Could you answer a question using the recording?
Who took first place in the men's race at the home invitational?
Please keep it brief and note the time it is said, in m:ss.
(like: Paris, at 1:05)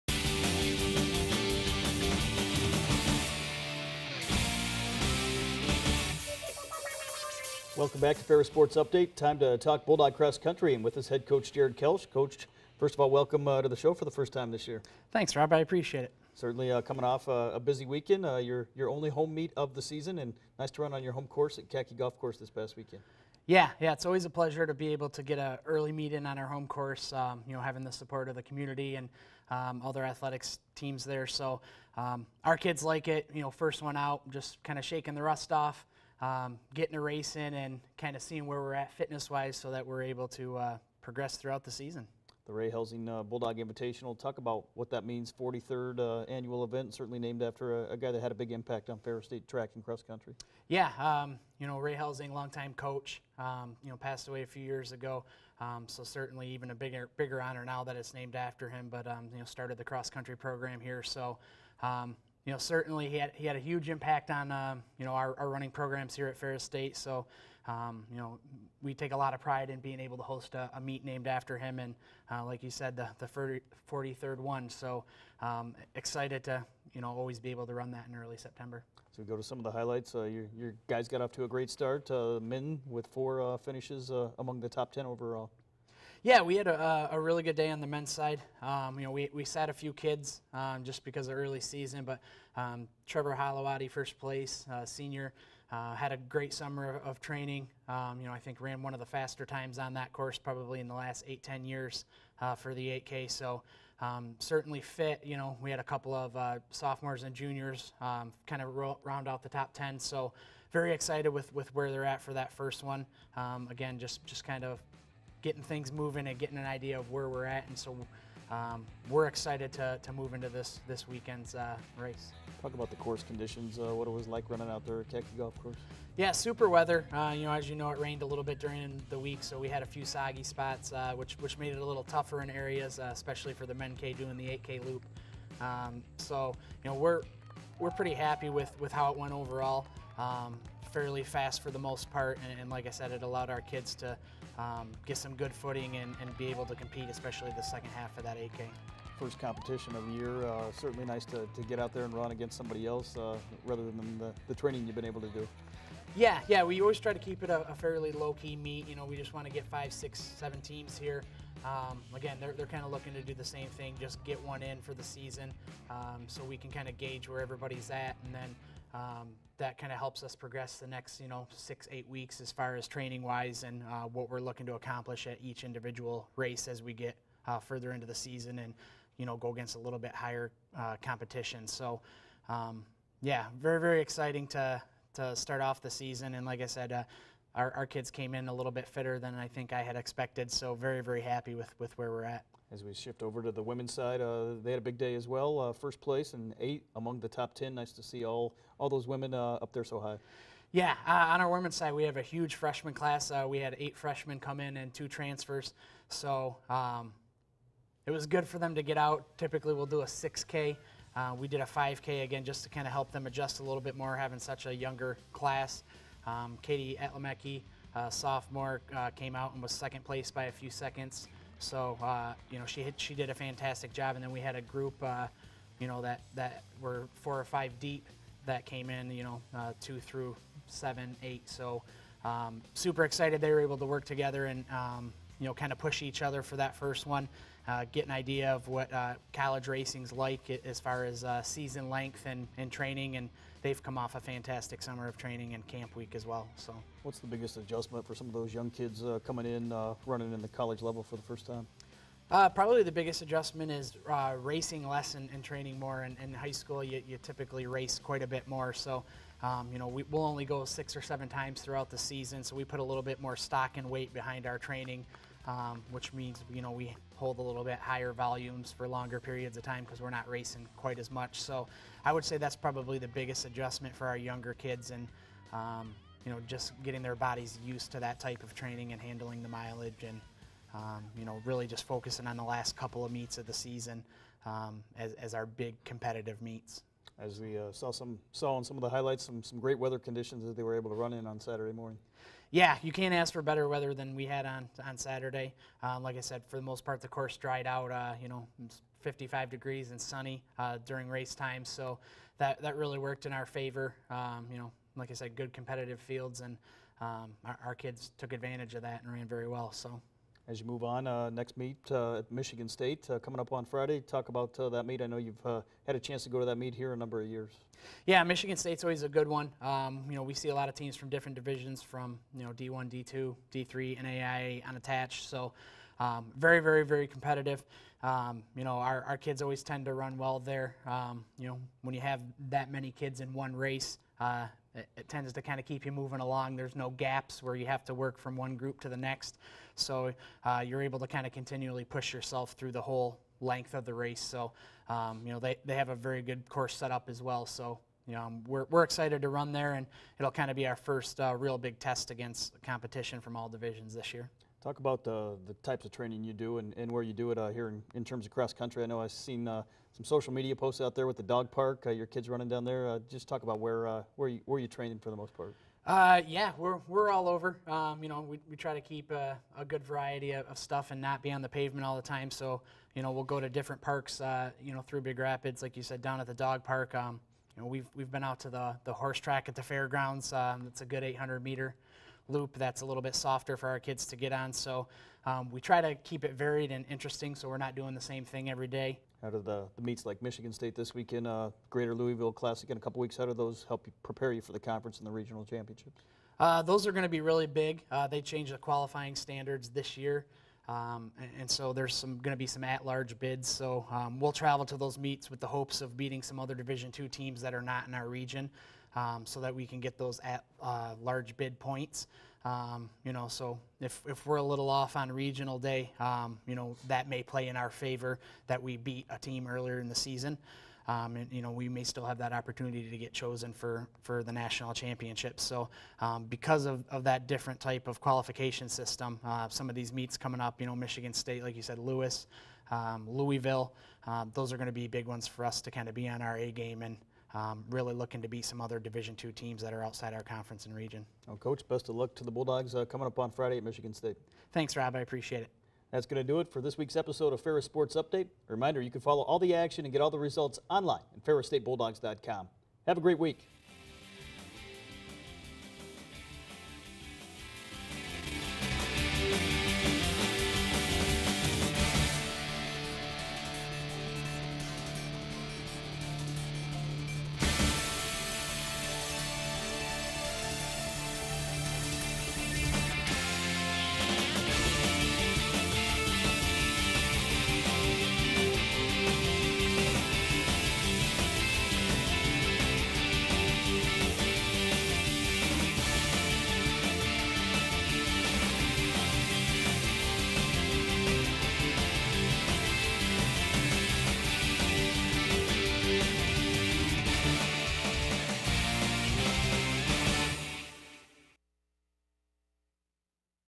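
Trevor Hollowati, at 1:33.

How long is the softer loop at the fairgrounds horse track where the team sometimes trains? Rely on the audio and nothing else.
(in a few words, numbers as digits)
800 meters.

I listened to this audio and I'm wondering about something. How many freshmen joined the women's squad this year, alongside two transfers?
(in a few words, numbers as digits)
8.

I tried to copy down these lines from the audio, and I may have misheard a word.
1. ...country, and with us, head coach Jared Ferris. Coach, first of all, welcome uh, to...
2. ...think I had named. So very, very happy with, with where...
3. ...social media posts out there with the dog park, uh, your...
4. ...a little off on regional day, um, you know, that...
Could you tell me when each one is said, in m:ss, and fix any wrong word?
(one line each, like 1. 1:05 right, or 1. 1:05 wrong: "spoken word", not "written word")
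1. 0:10 wrong: "Kelsh", not "Ferris"
2. 3:09 wrong: "expected", not "named"
3. 6:00 right
4. 6:54 right.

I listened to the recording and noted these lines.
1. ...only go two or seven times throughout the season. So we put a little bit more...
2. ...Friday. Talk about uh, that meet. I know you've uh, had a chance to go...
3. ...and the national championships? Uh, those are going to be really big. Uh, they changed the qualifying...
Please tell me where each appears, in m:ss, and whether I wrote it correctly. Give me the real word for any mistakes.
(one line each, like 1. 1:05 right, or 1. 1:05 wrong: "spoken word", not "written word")
1. 4:20 wrong: "six", not "two"
2. 5:13 right
3. 6:34 wrong: "regional", not "national".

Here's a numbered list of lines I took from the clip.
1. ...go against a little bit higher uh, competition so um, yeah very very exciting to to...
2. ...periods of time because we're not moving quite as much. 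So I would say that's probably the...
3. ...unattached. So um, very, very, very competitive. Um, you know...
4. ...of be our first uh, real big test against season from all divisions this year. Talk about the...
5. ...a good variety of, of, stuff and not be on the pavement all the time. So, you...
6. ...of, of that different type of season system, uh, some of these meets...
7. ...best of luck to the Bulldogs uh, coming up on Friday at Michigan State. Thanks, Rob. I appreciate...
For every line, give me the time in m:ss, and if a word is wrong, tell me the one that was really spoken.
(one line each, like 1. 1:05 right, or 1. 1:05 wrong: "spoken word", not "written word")
1. 2:59 right
2. 4:29 wrong: "racing", not "moving"
3. 5:24 right
4. 5:50 wrong: "competition", not "season"
5. 6:09 right
6. 7:06 wrong: "qualification", not "season"
7. 7:21 right.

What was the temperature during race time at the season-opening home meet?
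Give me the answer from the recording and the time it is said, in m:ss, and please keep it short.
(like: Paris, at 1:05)
55 degrees, at 4:58.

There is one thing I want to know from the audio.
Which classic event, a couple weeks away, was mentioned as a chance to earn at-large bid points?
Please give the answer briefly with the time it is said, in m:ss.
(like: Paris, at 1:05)
Greater Louisville Classic, at 6:31.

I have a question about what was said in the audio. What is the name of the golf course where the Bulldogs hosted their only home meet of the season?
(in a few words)
Katke Golf Course.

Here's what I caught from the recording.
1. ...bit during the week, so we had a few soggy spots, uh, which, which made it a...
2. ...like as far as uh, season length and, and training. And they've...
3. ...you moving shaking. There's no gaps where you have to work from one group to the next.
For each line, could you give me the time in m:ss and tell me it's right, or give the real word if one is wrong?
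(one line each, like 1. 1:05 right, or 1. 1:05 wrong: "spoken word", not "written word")
1. 2:08 right
2. 4:00 right
3. 5:35 wrong: "along", not "shaking".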